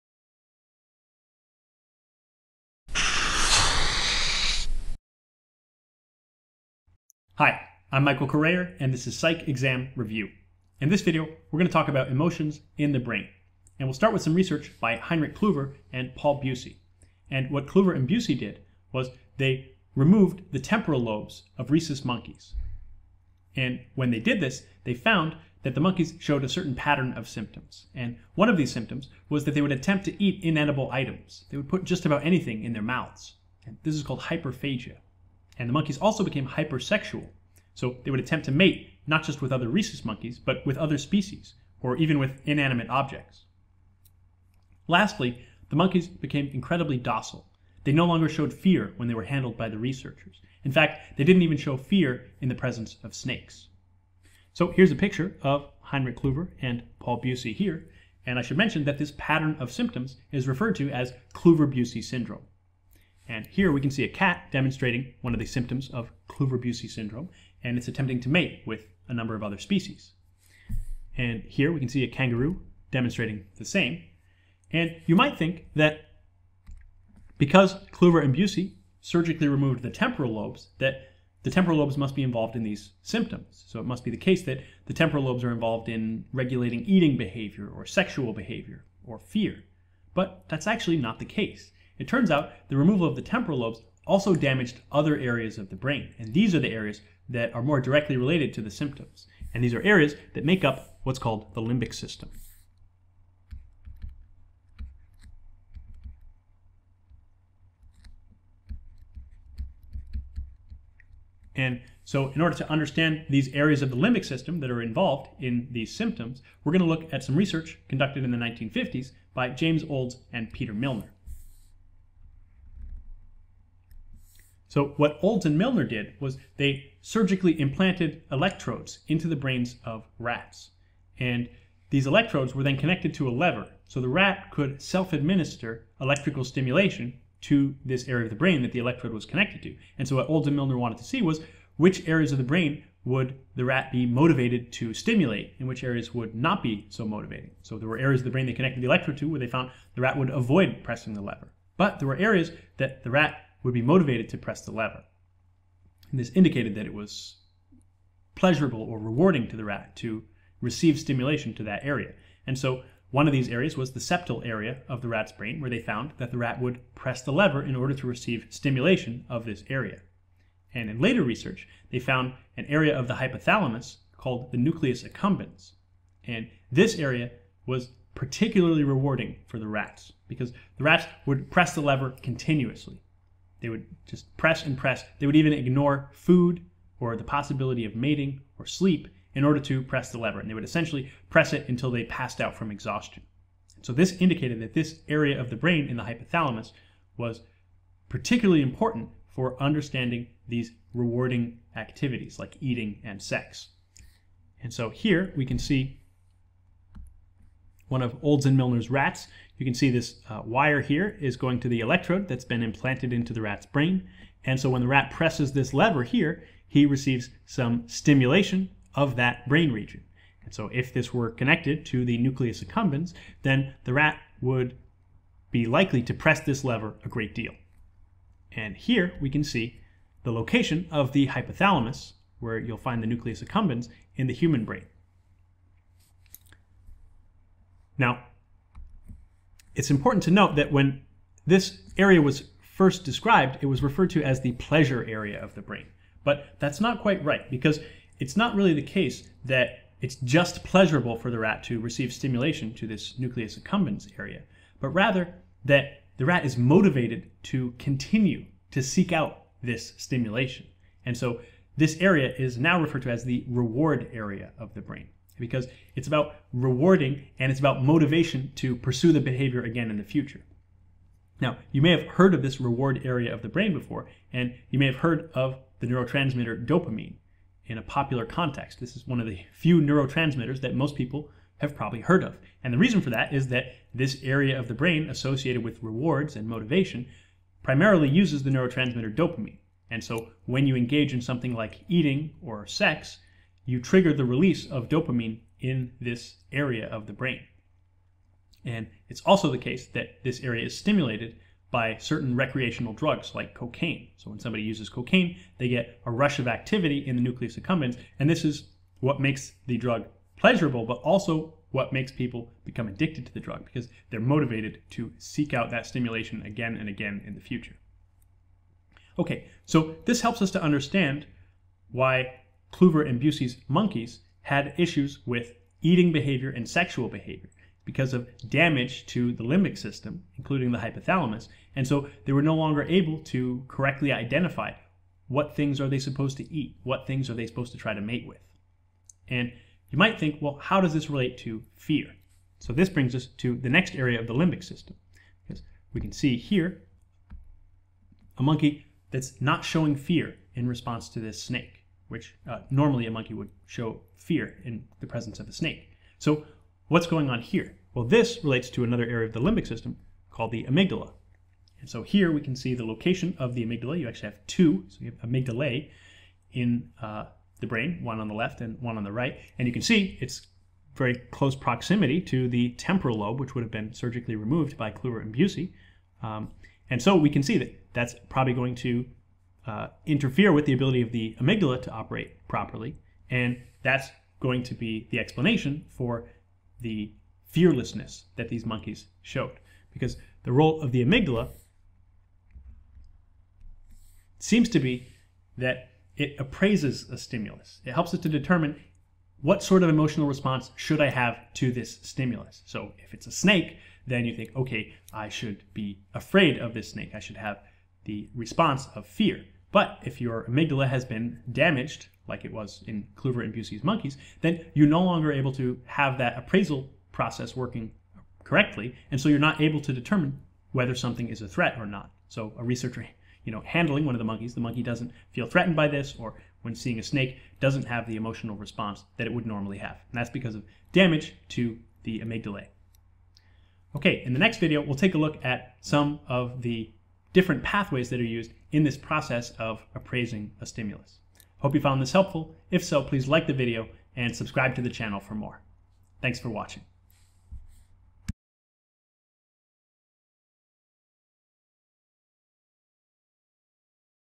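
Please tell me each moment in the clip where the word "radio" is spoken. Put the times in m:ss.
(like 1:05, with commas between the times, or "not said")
not said.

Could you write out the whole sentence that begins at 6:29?
Because the role of the amygdala seems to be that it appraises a stimulus.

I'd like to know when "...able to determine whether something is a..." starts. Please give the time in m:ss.
6:59.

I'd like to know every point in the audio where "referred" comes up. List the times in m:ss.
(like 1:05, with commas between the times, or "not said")
1:00, 4:03, 4:22.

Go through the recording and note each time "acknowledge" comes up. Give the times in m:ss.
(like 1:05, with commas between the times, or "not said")
not said.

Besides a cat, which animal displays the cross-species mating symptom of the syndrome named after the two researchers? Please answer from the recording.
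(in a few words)
Kangaroo.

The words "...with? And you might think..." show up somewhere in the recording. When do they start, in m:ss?
5:38.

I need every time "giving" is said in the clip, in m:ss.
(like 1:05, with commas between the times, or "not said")
not said.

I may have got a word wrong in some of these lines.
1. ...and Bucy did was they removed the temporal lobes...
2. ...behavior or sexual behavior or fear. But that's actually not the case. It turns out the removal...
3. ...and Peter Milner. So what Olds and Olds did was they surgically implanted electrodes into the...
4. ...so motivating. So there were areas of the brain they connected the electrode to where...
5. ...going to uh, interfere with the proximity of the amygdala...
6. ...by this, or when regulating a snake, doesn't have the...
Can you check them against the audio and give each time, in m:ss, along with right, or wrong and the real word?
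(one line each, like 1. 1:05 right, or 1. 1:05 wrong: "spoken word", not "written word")
1. 0:17 right
2. 1:27 right
3. 2:00 wrong: "Milner", not "Olds"
4. 2:26 right
5. 6:18 wrong: "ability", not "proximity"
6. 7:05 wrong: "seeing", not "regulating".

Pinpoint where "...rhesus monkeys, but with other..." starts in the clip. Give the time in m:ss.
0:39.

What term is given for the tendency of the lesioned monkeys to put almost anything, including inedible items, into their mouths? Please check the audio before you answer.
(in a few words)
Hyperphagia.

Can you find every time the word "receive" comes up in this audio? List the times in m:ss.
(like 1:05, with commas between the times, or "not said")
2:40, 2:48, 3:36, 4:11.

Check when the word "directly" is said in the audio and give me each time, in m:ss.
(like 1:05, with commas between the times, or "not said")
1:37.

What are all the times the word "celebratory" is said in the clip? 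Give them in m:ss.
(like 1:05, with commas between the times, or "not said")
not said.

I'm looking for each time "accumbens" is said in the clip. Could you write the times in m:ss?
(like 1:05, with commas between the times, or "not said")
2:55, 3:42, 3:53, 4:13, 5:07.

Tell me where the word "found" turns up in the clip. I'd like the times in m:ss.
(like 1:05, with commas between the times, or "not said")
0:24, 2:29, 2:45, 2:51, 7:21.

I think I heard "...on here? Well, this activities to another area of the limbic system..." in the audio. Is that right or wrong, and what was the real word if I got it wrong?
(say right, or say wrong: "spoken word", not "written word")
wrong: "relates", not "activities".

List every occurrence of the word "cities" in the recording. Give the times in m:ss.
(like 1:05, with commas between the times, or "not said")
not said.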